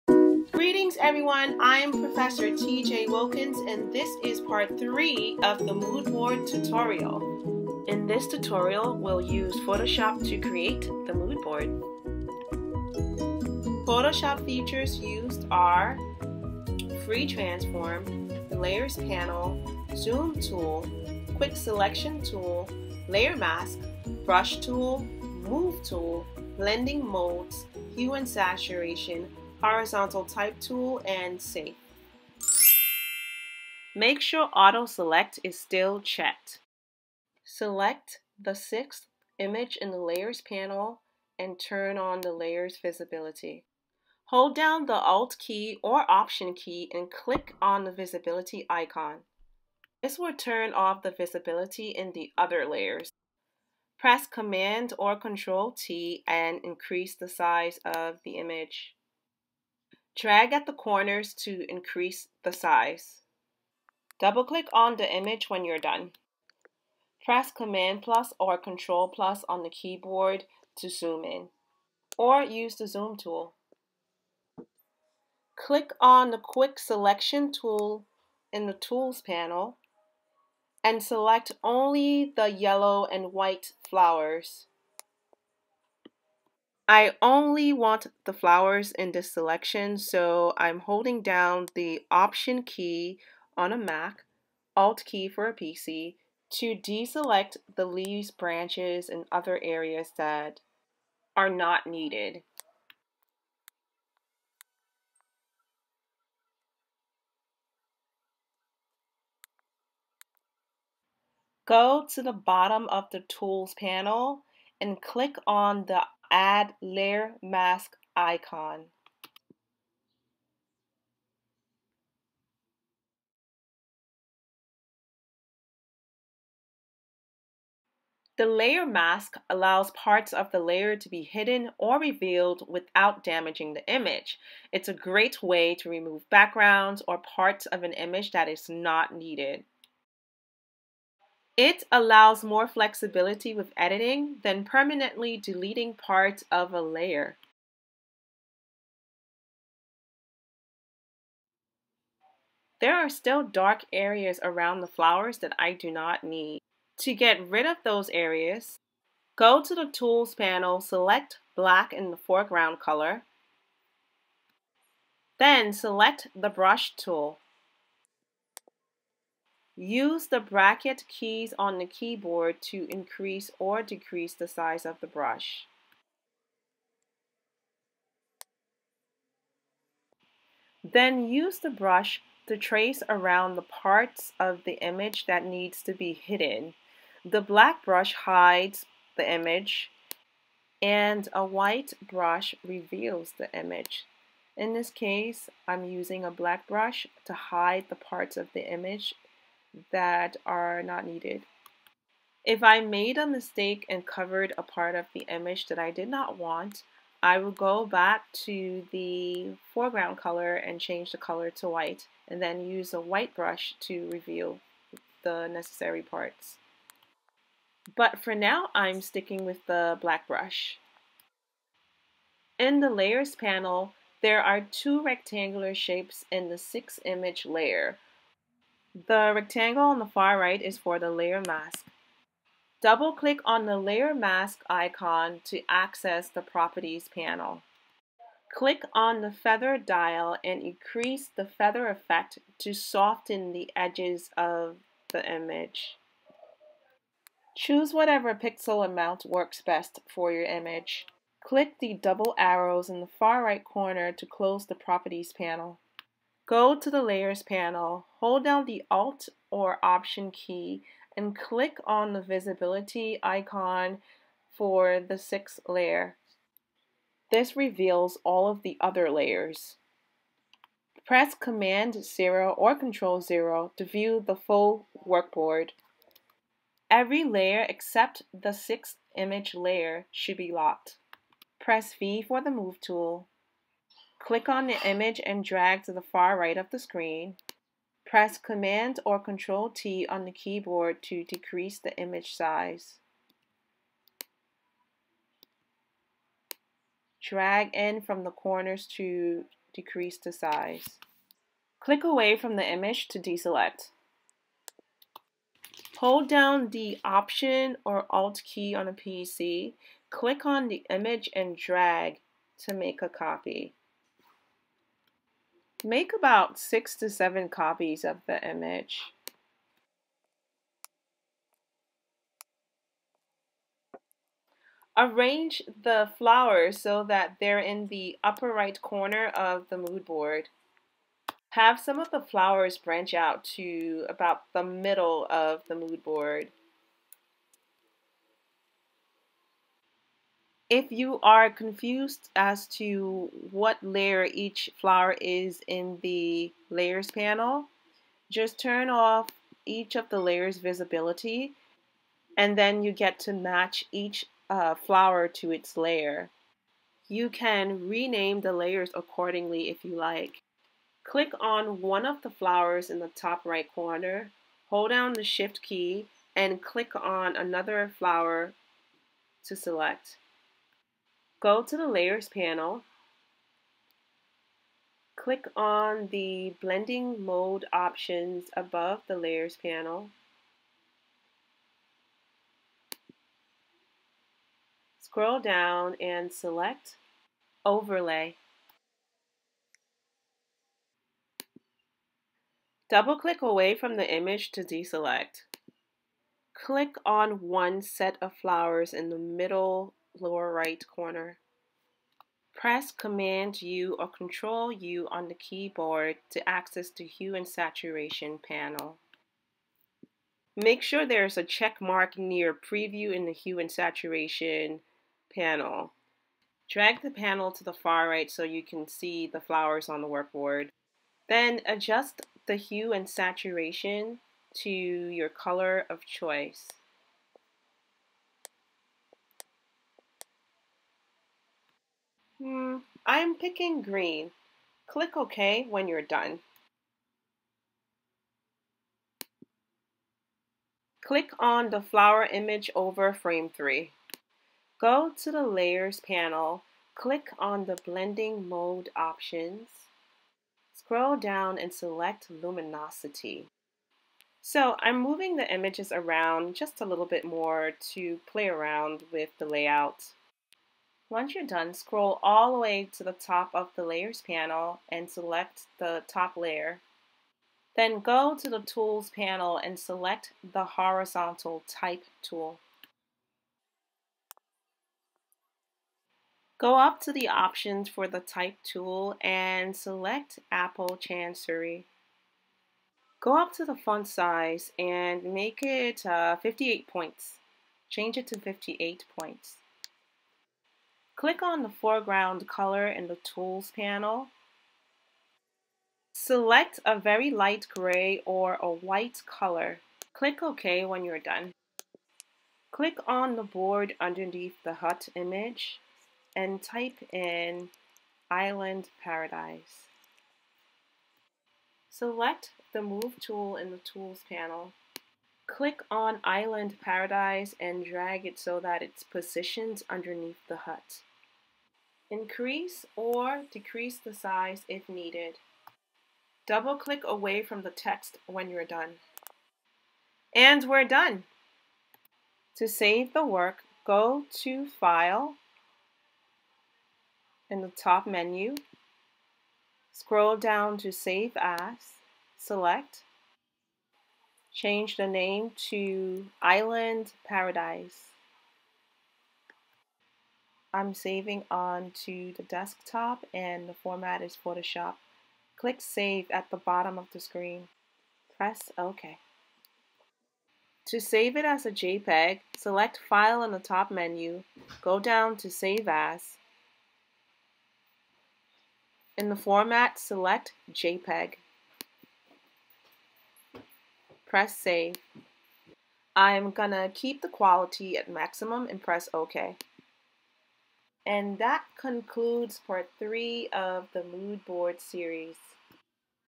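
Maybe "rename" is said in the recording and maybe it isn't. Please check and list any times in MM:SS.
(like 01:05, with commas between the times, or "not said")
05:57.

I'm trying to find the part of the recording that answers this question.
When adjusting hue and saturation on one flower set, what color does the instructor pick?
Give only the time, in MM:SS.
07:13.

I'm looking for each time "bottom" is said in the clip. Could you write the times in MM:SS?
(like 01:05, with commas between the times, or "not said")
01:52, 09:16.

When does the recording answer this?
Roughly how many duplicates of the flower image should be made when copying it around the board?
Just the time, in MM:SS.
05:16.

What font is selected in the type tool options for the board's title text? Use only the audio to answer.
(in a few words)
Apple Chancery.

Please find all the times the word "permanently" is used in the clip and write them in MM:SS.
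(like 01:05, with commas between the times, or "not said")
02:24.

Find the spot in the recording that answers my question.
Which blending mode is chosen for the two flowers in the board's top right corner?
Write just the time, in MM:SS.
06:27.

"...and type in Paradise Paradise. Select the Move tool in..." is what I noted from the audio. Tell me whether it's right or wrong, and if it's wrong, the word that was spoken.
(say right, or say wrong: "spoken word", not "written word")
wrong: "Island", not "Paradise".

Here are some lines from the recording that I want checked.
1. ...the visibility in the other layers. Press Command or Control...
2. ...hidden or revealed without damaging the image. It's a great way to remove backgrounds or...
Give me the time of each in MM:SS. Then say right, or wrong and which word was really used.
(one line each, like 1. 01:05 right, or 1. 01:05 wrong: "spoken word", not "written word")
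1. 00:51 right
2. 02:11 right.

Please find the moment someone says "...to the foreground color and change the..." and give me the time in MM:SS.
03:28.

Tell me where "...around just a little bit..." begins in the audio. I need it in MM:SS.
07:35.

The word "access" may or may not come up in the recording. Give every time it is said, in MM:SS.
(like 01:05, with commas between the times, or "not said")
03:55, 06:46.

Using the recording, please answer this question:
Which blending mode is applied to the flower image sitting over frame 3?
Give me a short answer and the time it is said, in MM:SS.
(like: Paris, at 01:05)
Luminosity, at 07:32.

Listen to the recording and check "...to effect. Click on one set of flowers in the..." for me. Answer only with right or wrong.
wrong.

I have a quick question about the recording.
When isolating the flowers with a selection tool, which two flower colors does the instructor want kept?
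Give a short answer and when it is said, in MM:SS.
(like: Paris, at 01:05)
Yellow and white, at 01:22.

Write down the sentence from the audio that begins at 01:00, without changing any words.
Drag at the corners to increase the size.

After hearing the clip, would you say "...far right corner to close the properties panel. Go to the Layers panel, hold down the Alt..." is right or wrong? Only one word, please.
right.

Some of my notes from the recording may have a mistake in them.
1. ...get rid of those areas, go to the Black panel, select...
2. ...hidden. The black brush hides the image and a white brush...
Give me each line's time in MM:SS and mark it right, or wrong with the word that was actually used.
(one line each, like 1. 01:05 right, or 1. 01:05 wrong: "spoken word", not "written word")
1. 02:37 wrong: "Tools", not "Black"
2. 03:06 right.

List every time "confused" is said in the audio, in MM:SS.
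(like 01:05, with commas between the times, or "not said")
05:41.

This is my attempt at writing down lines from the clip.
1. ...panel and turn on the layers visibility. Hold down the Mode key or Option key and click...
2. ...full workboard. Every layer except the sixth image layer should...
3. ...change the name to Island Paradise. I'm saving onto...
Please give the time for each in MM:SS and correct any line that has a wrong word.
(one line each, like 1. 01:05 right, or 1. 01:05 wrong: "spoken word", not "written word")
1. 00:40 wrong: "Alt", not "Mode"
2. 04:34 right
3. 09:04 right.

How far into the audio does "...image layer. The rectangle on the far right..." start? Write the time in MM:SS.
03:47.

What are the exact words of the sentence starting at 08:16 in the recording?
Select a very light gray or a white color.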